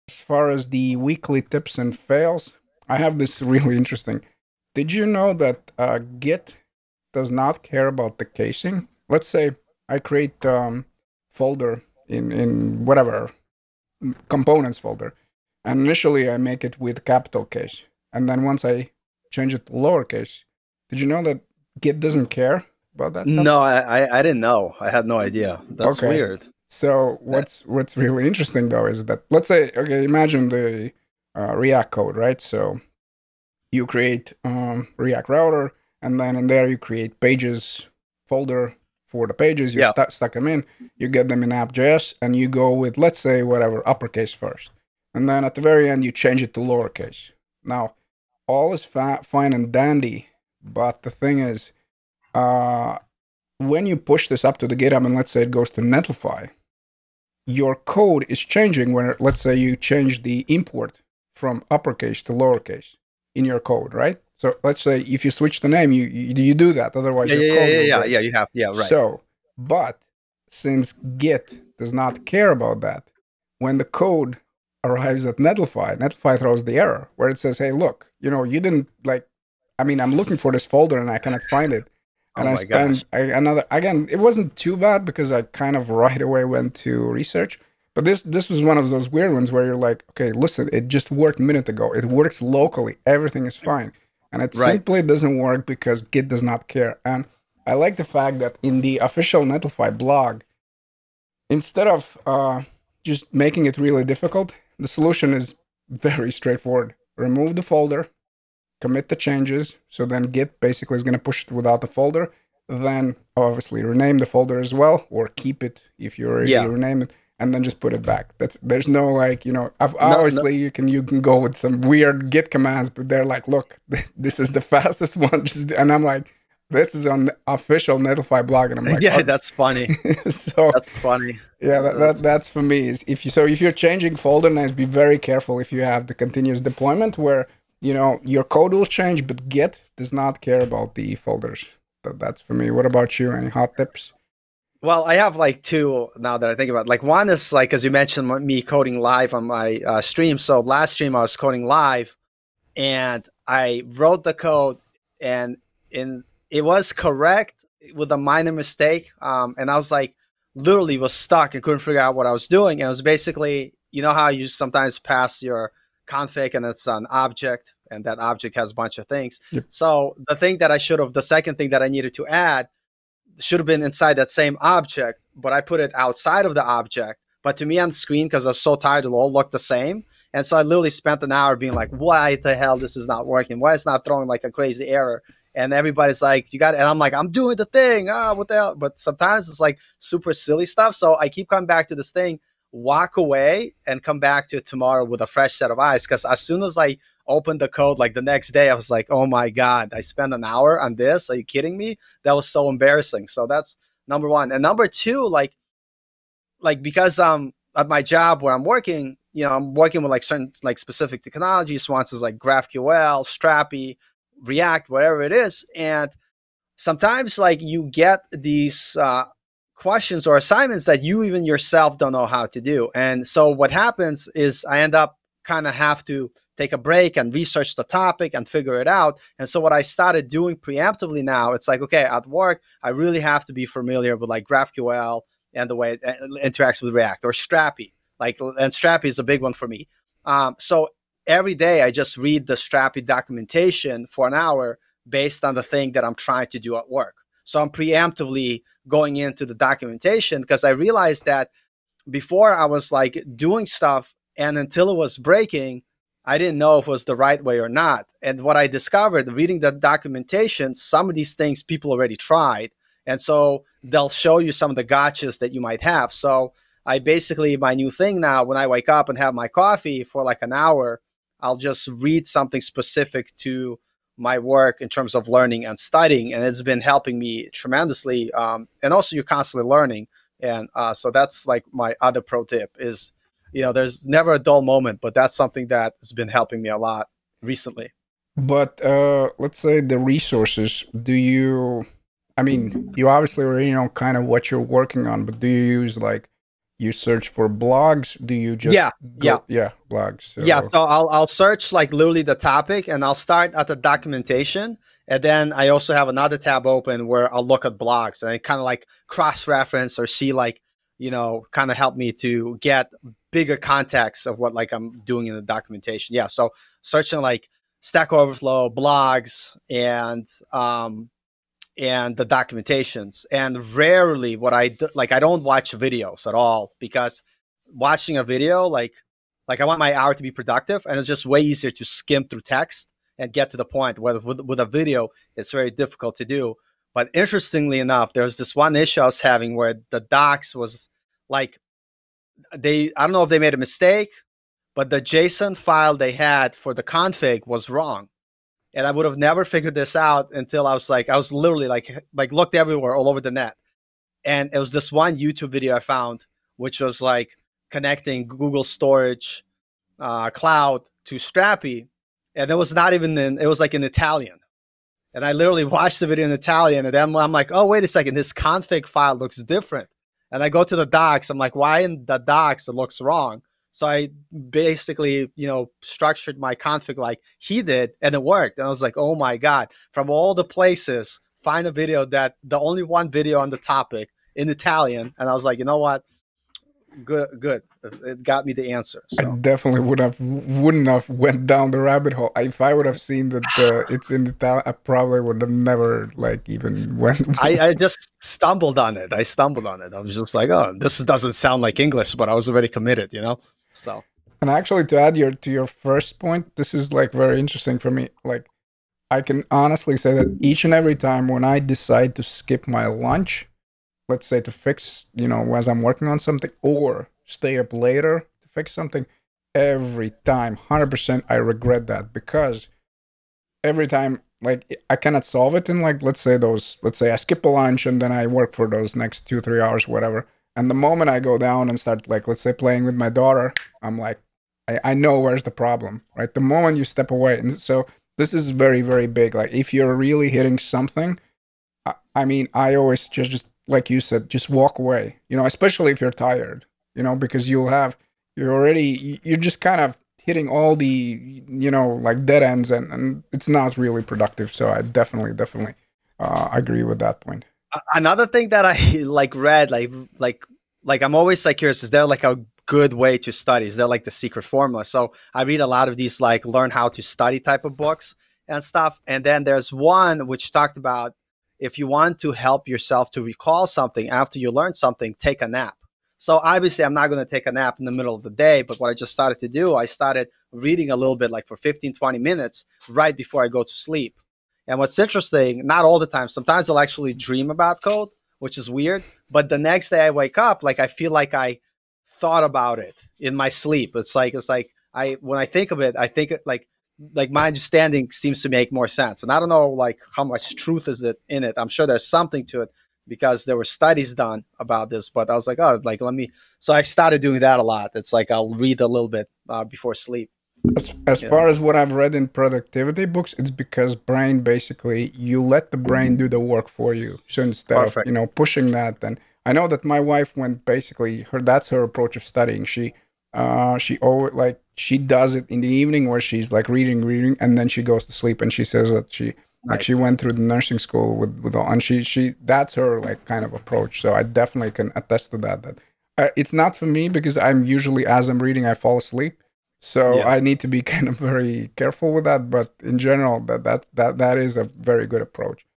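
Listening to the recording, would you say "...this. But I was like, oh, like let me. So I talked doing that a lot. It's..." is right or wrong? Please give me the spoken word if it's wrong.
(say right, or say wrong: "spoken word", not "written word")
wrong: "started", not "talked".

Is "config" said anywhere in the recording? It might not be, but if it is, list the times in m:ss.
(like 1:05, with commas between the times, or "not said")
2:46, 5:46, 6:08, 6:16.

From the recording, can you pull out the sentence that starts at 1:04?
So let's say if you switch the name, you you, you do that.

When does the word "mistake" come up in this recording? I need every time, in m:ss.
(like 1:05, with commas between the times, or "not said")
2:38, 5:43.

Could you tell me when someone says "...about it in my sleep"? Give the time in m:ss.
8:12.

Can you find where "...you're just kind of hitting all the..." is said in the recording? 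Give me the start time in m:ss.
7:29.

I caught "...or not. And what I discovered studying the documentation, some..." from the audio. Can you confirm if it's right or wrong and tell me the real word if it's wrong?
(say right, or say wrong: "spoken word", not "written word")
wrong: "reading", not "studying".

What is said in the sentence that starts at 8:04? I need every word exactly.
And what's interesting, not all the time, sometimes I'll actually dream about code, which is weird.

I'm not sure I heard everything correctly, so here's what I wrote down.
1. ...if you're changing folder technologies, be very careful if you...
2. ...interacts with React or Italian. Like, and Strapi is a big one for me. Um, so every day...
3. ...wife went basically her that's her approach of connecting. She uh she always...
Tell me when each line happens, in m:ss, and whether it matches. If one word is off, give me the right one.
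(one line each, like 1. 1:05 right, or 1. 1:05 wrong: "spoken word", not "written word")
1. 2:13 wrong: "names", not "technologies"
2. 3:56 wrong: "Strapi", not "Italian"
3. 8:39 wrong: "studying", not "connecting".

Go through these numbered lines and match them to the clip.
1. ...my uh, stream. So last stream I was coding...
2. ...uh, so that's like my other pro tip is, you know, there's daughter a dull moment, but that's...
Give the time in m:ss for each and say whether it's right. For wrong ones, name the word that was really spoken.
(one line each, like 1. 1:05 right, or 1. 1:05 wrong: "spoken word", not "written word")
1. 2:29 right
2. 4:40 wrong: "never", not "daughter".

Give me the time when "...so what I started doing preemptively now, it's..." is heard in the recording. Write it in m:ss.
3:49.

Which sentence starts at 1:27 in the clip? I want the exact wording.
But this this was one of those weird ones where you're like, okay, listen, it just worked a minute ago.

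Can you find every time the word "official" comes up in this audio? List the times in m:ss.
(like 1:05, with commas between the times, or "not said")
1:38, 2:07.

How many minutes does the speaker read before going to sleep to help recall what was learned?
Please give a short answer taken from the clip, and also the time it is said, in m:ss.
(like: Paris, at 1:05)
15 to 20 minutes, at 8:01.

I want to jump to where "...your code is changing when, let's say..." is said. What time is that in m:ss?
0:57.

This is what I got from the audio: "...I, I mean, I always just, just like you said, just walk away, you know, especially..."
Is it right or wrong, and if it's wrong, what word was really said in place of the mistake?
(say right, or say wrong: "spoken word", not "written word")
right.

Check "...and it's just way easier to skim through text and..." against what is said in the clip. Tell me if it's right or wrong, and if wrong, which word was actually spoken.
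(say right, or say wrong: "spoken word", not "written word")
right.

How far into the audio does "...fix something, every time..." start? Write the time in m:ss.
6:58.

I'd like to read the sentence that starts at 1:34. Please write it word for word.
simply doesn't work because Git does not care.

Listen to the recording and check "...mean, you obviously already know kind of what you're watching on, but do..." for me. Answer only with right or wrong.
wrong.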